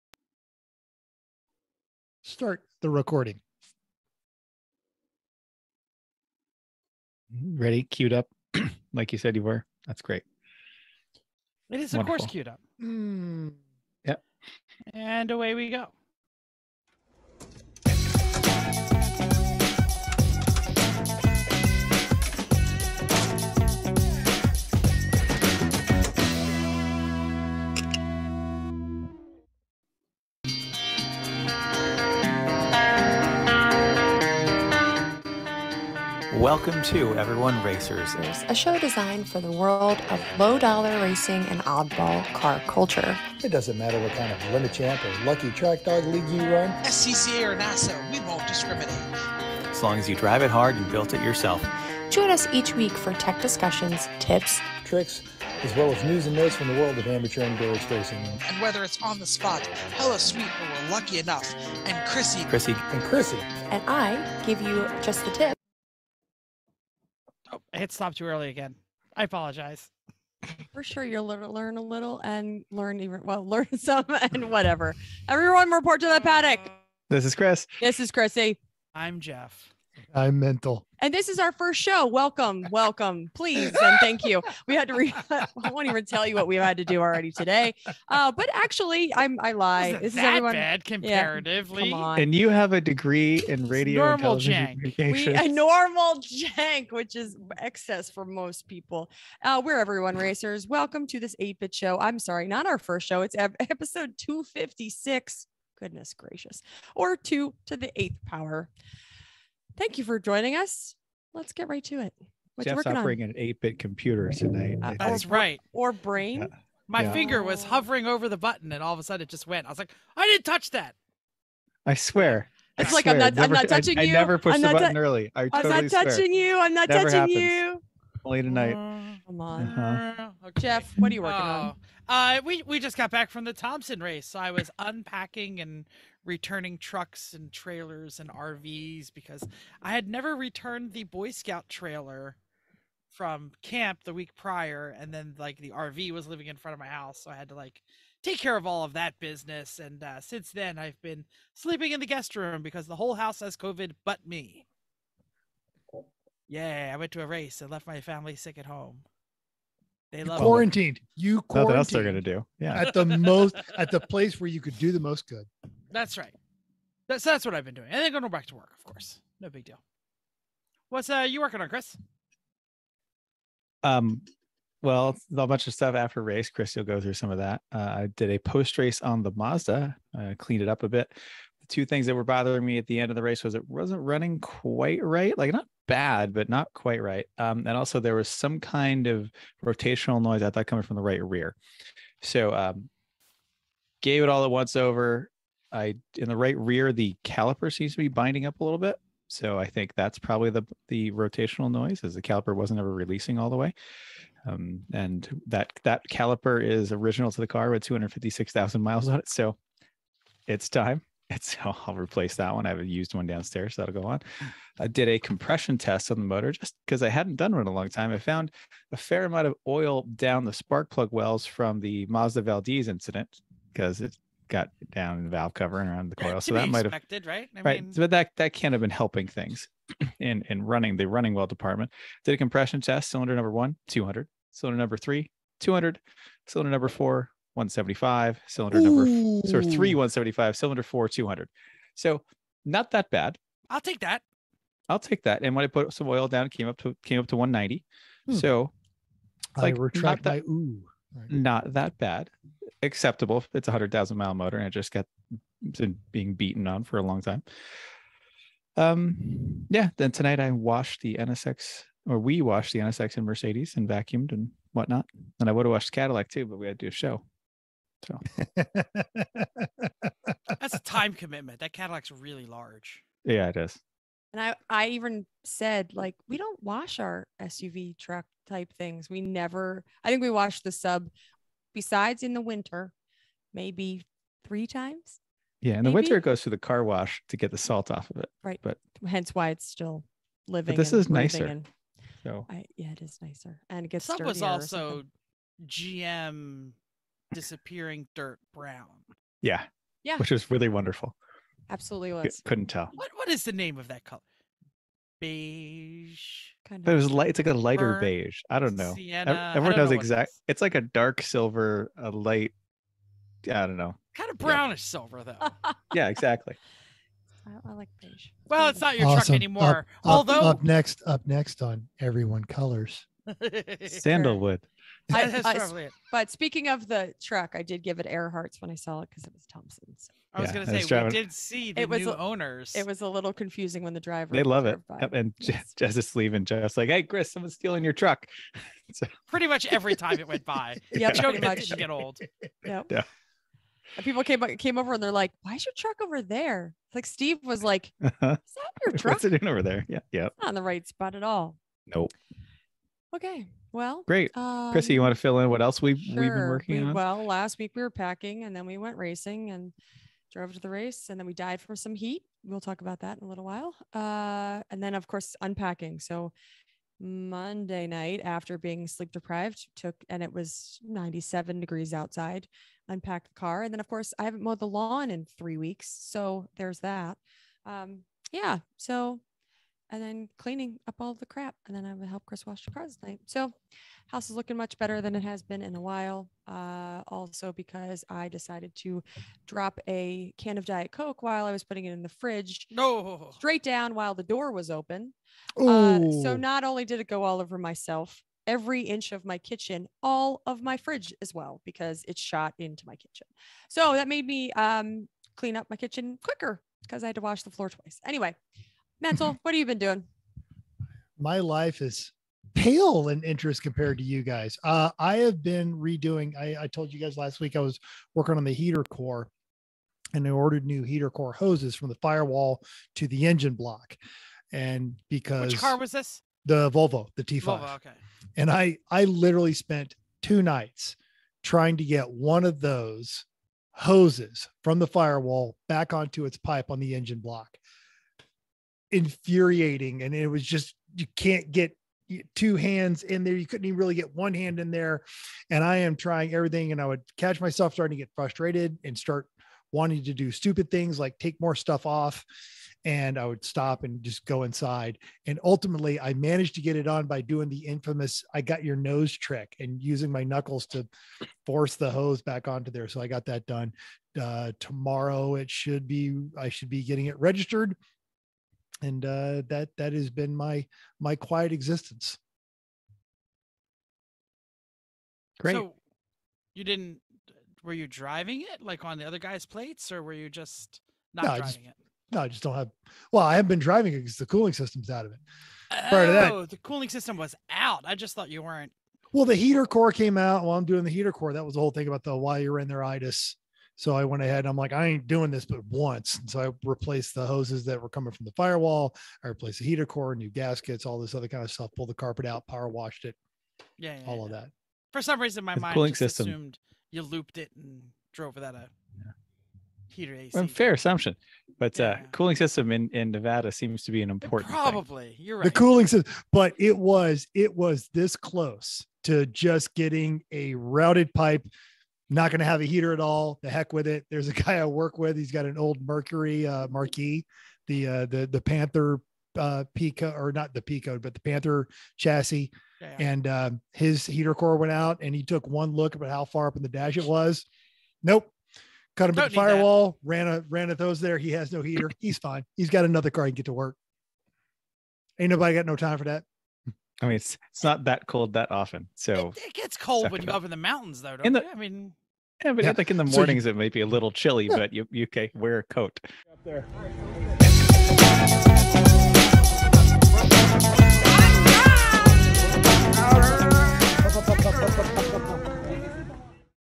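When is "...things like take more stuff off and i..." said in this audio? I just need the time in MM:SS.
07:30.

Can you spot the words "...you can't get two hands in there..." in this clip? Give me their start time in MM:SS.
07:20.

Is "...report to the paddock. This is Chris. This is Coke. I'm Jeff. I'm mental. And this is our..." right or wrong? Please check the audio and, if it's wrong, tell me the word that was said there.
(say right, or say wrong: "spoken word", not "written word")
wrong: "Chrissy", not "Coke".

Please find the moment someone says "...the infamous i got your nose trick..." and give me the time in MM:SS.
07:37.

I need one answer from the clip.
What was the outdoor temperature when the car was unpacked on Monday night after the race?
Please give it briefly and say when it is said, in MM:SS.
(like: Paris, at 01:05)
97 degrees, at 06:10.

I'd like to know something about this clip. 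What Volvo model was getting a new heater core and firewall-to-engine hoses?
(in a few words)
T5.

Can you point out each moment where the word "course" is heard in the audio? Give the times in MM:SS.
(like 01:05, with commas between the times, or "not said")
00:12, 02:48, 06:05, 06:13.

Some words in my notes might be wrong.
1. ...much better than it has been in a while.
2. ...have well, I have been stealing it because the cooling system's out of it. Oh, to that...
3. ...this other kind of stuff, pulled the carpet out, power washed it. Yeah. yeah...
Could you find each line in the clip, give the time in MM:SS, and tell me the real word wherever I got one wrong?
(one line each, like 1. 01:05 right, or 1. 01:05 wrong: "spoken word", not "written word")
1. 06:24 right
2. 08:02 wrong: "driving", not "stealing"
3. 08:20 right.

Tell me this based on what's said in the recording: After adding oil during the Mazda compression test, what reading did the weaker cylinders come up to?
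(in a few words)
190.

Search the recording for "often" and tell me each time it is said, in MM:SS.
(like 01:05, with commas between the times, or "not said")
09:08.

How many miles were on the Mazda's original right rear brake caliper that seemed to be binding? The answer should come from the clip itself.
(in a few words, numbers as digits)
256,000.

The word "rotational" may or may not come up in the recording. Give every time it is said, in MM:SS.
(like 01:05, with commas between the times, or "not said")
03:09, 03:21.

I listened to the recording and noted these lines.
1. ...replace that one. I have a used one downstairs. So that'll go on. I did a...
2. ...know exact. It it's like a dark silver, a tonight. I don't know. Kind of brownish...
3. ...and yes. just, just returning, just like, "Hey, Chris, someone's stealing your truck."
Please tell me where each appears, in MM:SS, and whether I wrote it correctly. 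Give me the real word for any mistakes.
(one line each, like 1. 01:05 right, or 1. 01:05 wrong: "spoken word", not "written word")
1. 03:31 right
2. 05:09 wrong: "light", not "tonight"
3. 05:35 wrong: "leaving", not "returning".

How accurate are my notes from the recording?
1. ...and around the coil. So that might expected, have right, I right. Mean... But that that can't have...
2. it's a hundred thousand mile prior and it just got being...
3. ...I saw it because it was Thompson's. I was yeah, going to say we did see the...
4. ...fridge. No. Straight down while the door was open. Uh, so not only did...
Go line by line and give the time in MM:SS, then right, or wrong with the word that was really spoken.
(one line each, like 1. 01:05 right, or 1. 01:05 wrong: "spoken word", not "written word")
1. 03:45 right
2. 04:13 wrong: "motor", not "prior"
3. 05:28 right
4. 06:32 right.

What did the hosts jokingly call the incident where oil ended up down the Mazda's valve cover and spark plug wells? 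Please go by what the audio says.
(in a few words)
Mazda Valdez incident.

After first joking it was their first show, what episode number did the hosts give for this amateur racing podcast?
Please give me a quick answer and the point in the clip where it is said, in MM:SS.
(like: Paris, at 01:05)
256, at 01:44.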